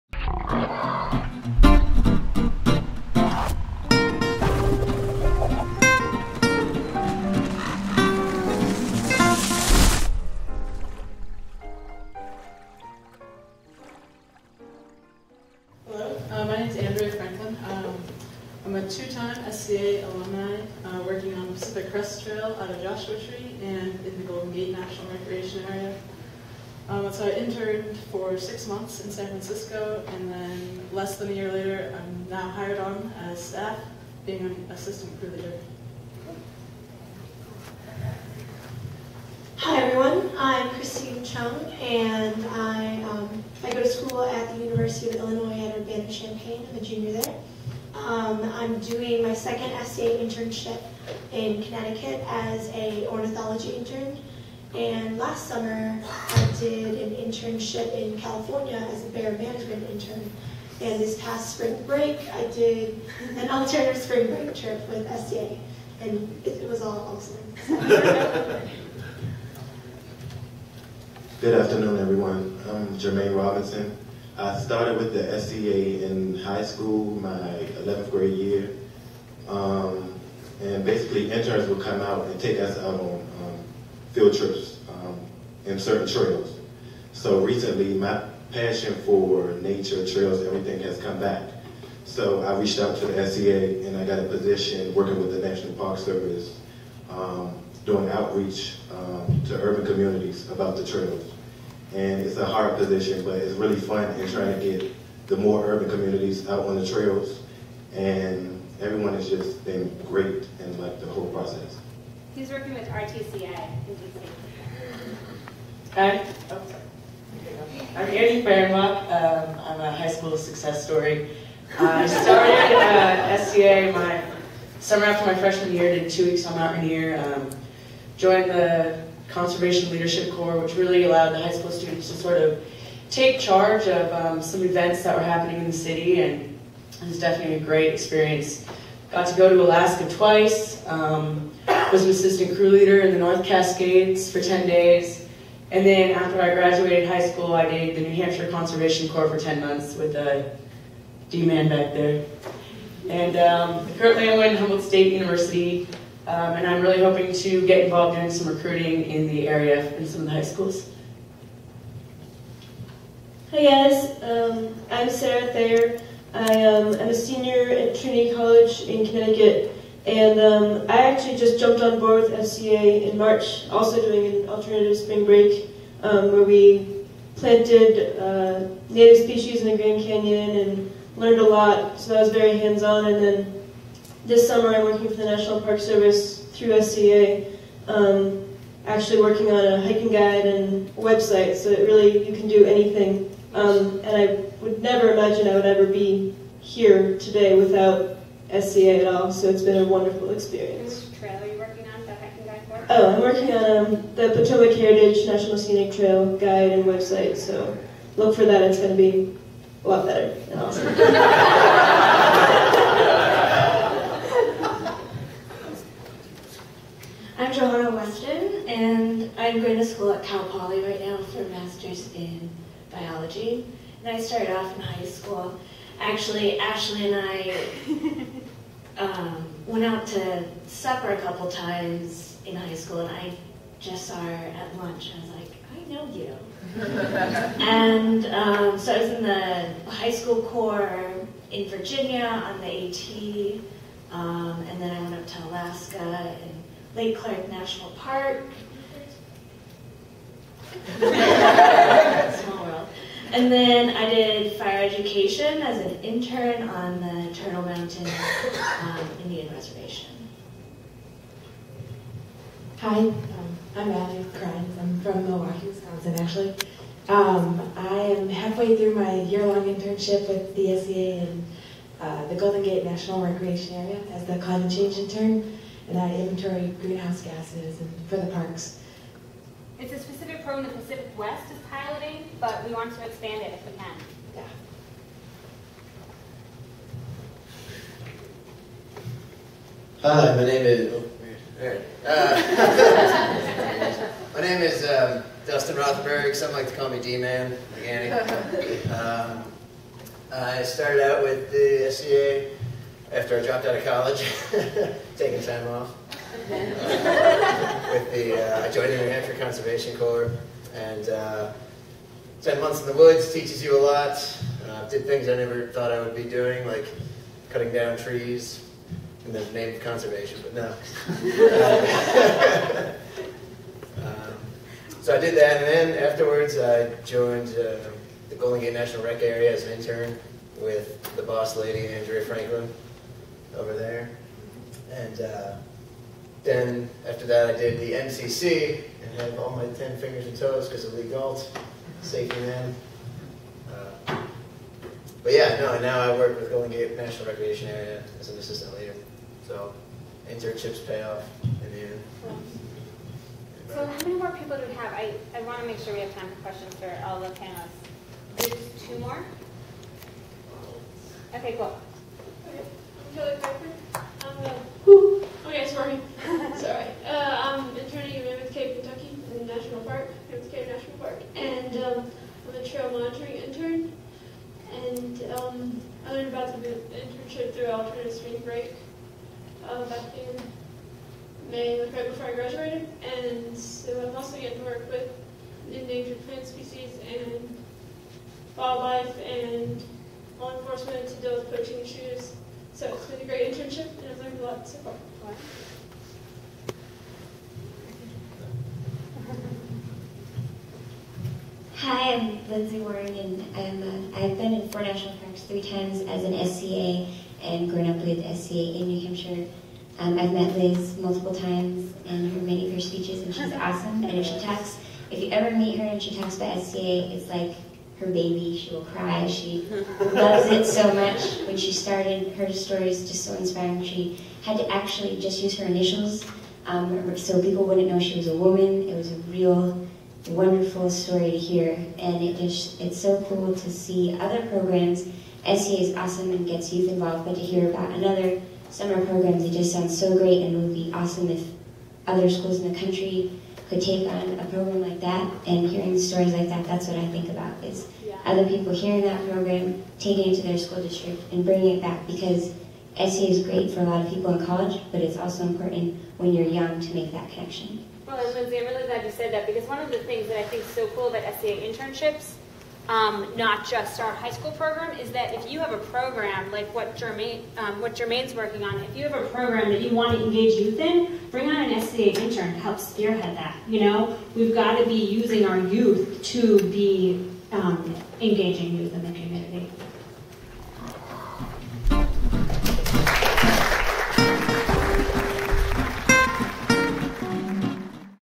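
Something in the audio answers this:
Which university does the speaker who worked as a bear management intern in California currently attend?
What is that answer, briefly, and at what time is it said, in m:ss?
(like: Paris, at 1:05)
University of Illinois at Urbana-Champaign, at 0:44.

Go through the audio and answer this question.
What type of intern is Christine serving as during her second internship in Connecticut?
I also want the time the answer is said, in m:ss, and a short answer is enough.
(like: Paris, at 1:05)
ornithology intern, at 0:53.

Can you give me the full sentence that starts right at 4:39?
It's a specific program the Pacific West is piloting, but we want to expand it if we can.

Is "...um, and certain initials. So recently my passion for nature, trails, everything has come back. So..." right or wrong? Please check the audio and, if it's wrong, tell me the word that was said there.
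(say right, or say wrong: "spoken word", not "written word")
wrong: "trails", not "initials".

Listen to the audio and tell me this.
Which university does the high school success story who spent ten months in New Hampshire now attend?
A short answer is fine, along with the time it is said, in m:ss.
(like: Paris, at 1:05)
Humboldt State University, at 2:34.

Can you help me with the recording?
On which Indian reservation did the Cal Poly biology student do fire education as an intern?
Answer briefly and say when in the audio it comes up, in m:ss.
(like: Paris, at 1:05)
Turtle Mountain, at 4:17.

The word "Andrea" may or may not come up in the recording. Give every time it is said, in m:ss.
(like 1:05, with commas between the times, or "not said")
5:31.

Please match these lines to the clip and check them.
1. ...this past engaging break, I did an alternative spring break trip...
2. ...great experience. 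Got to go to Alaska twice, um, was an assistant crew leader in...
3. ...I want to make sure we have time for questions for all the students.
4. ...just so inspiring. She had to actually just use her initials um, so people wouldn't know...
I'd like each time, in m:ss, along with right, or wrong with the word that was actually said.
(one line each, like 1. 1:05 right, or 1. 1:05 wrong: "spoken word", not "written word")
1. 1:01 wrong: "spring", not "engaging"
2. 2:17 right
3. 5:55 wrong: "panelists", not "students"
4. 7:03 right.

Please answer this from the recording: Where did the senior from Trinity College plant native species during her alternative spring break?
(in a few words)
Grand Canyon.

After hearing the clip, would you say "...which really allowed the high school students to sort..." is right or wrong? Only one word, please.
right.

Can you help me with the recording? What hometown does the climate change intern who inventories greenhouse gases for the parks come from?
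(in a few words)
Milwaukee, Wisconsin.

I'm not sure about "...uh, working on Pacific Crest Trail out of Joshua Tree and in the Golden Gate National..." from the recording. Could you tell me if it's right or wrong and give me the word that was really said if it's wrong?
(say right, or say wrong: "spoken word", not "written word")
right.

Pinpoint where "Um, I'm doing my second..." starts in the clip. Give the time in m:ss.
0:47.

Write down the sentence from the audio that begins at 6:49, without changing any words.
Um, I've met Liz multiple times and heard many of her speeches, and she's awesome.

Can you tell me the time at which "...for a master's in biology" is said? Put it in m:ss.
3:41.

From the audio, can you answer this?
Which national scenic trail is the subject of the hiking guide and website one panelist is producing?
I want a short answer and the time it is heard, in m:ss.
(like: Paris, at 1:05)
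Potomac Heritage National Scenic Trail, at 3:24.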